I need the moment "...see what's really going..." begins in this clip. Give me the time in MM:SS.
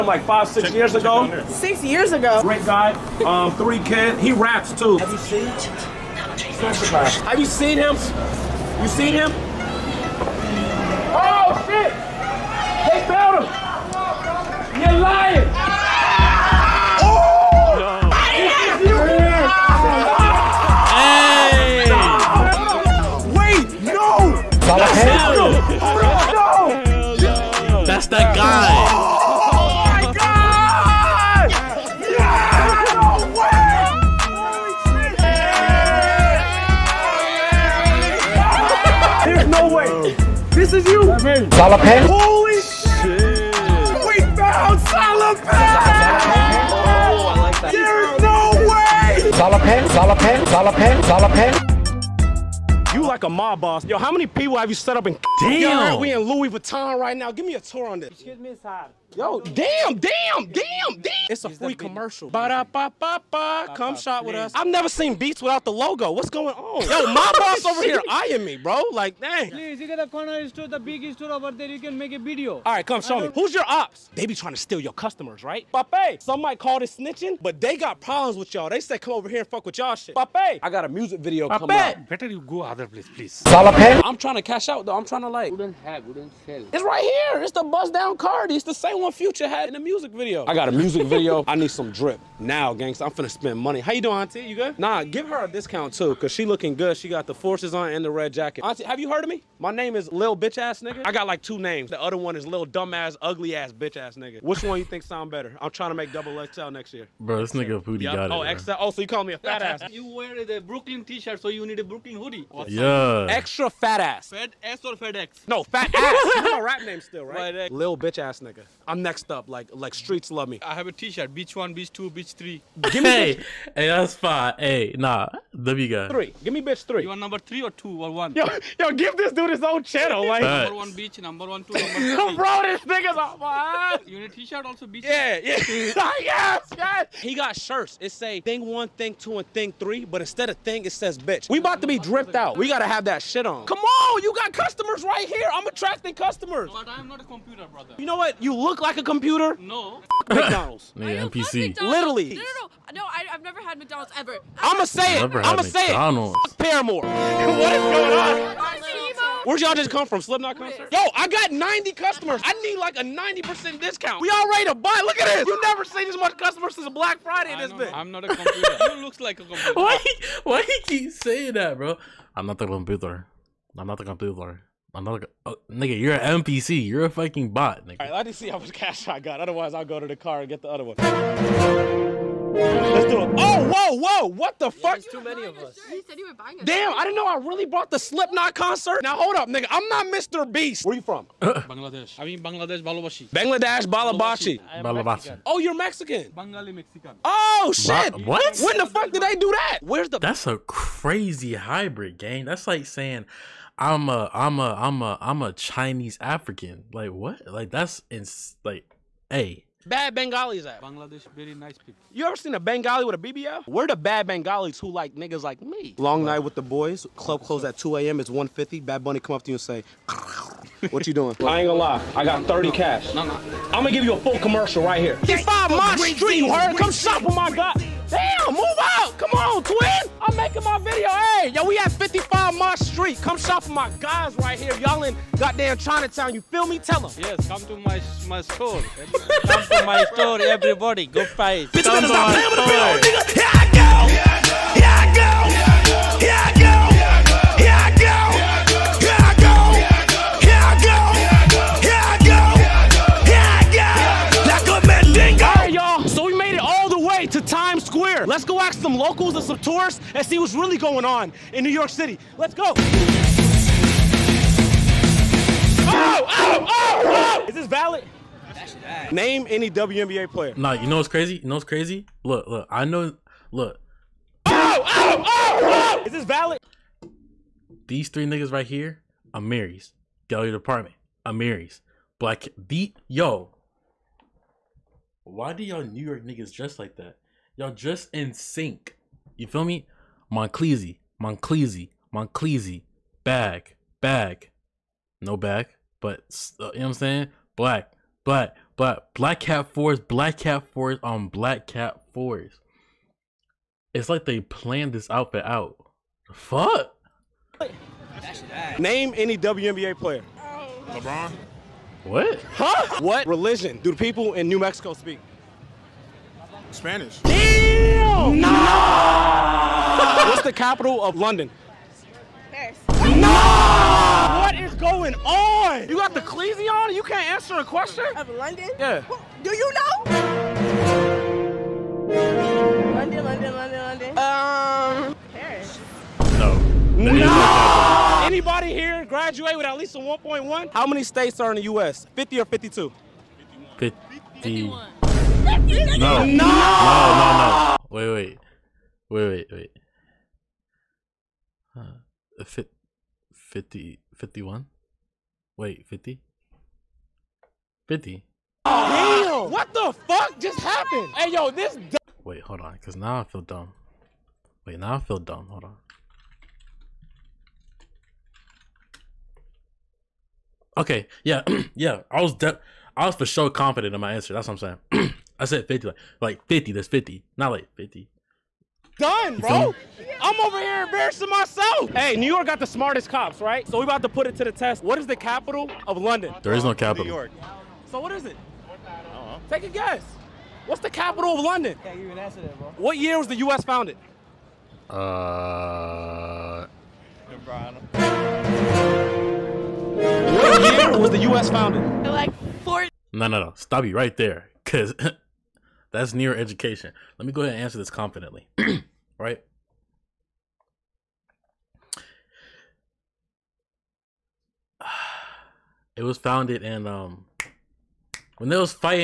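04:20.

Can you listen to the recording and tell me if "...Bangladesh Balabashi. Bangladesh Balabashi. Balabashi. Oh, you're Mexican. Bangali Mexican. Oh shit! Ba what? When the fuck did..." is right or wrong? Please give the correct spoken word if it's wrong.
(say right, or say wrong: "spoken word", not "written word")
right.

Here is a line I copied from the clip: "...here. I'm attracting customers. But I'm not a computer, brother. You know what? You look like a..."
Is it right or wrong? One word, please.
right.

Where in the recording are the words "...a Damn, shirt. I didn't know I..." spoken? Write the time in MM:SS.
03:06.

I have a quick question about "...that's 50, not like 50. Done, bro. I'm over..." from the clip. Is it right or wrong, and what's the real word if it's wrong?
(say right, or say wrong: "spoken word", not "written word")
right.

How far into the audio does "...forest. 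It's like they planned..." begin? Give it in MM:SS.
05:02.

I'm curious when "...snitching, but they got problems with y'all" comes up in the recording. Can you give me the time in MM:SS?
01:16.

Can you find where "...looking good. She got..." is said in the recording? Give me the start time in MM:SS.
01:36.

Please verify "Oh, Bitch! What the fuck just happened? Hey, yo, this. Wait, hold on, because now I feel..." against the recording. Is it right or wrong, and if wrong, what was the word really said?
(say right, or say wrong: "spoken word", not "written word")
wrong: "Damn", not "Bitch".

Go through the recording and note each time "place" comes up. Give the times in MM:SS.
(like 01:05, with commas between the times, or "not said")
01:22.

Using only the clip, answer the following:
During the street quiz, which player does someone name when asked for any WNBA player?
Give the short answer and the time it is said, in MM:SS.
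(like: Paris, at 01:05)
LeBron, at 05:10.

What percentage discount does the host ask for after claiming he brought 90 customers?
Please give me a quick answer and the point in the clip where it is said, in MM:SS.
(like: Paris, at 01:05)
90%, at 02:43.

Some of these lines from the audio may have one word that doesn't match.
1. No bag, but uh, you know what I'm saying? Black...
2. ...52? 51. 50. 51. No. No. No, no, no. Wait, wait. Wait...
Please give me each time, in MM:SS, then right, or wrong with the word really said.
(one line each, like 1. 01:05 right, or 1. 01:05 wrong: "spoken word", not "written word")
1. 04:55 right
2. 05:42 right.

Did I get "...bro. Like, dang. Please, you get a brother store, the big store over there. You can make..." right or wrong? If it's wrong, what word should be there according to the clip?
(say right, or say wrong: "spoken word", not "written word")
wrong: "corner", not "brother".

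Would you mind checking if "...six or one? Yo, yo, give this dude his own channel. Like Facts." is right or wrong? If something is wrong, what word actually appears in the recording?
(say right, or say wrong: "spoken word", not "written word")
wrong: "two", not "six".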